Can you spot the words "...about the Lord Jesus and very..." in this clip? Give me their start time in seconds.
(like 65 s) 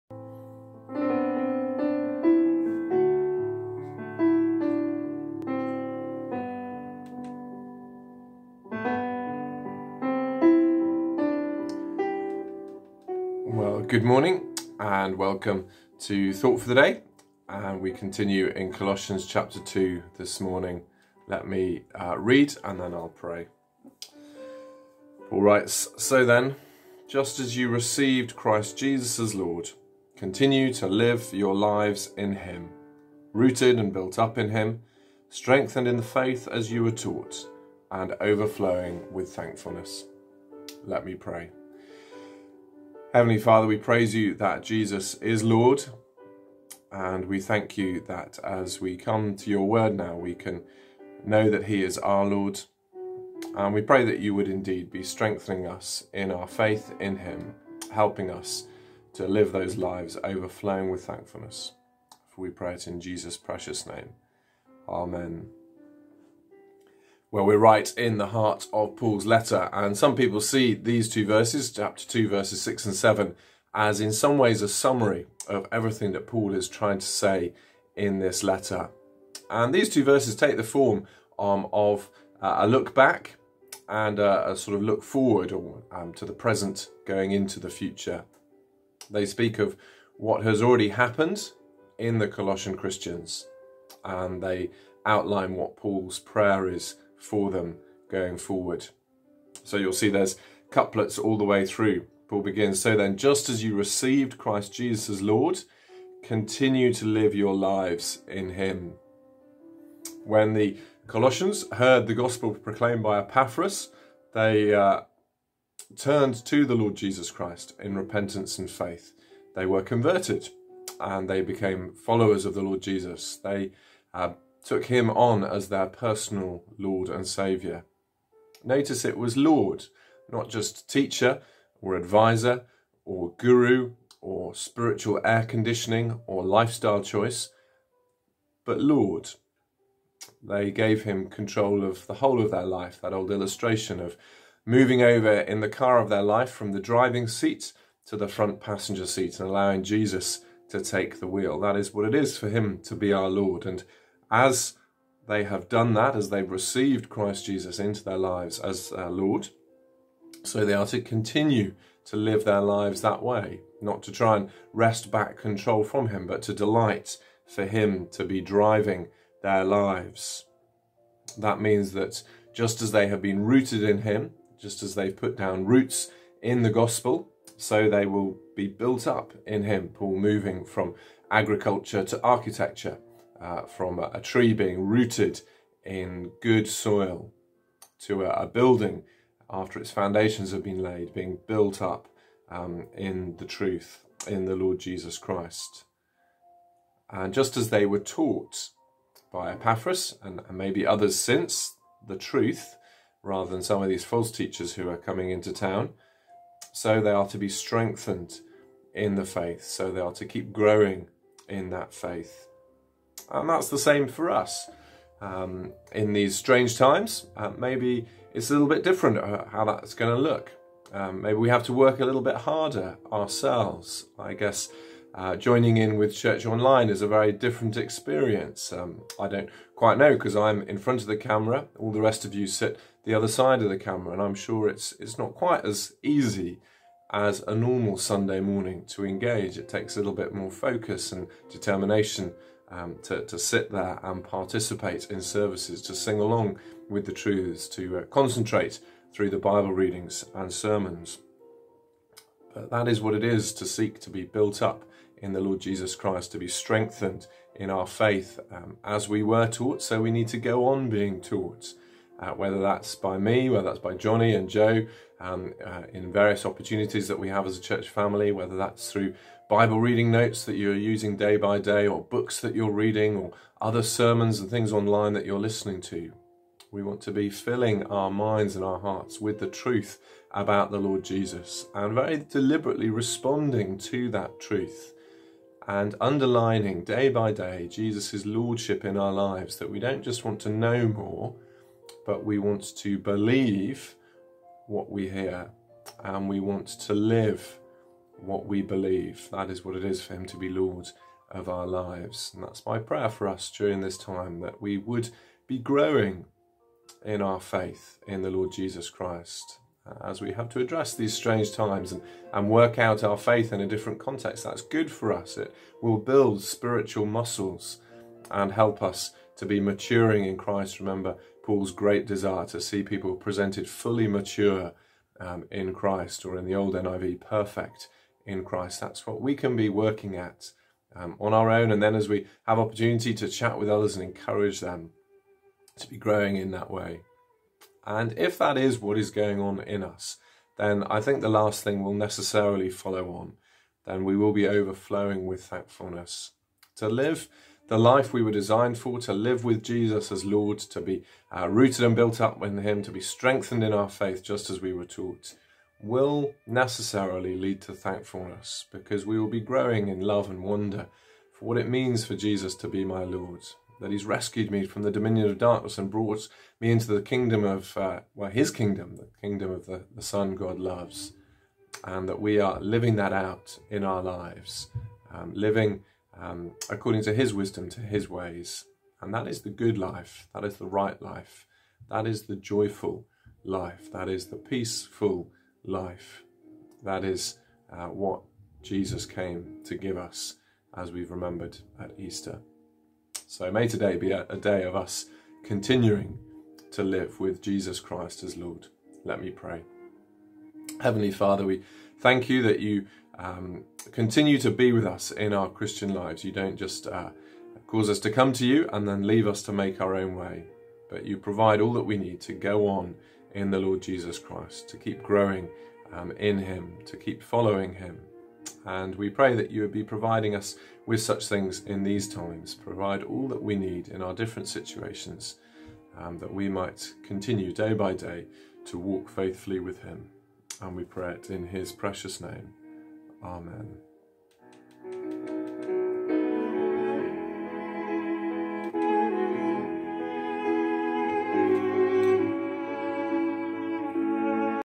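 280 s.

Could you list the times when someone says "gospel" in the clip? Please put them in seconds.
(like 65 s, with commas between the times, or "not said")
112 s, 176 s.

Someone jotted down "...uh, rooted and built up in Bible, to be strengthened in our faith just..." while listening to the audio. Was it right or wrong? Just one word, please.
wrong.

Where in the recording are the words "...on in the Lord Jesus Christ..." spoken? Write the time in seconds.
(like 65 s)
412 s.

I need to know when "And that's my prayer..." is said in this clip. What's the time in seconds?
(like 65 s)
302 s.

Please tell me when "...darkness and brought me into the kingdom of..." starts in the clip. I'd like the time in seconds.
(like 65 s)
365 s.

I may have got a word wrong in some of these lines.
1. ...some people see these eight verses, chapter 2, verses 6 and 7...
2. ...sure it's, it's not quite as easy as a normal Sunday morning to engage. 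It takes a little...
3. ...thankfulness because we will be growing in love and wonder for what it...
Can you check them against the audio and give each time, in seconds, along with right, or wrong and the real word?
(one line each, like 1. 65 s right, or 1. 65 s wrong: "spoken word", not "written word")
1. 69 s wrong: "two", not "eight"
2. 234 s right
3. 357 s right.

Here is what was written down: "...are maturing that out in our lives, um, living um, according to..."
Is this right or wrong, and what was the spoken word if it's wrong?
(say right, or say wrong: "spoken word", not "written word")
wrong: "living", not "maturing".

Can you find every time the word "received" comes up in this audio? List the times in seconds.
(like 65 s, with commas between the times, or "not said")
27 s, 103 s, 156 s.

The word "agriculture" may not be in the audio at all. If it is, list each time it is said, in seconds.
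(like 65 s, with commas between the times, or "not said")
181 s.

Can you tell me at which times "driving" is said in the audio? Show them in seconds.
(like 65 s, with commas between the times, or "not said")
146 s, 168 s.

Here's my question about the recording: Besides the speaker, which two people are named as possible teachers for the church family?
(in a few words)
Johnny and Joe.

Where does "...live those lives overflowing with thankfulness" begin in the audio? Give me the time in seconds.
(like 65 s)
59 s.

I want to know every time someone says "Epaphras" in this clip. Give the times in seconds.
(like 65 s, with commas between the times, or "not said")
113 s, 199 s.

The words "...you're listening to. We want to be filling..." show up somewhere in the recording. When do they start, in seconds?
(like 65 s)
275 s.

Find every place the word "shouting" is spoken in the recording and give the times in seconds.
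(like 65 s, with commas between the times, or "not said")
not said.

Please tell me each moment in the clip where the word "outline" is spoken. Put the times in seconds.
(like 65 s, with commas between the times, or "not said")
95 s.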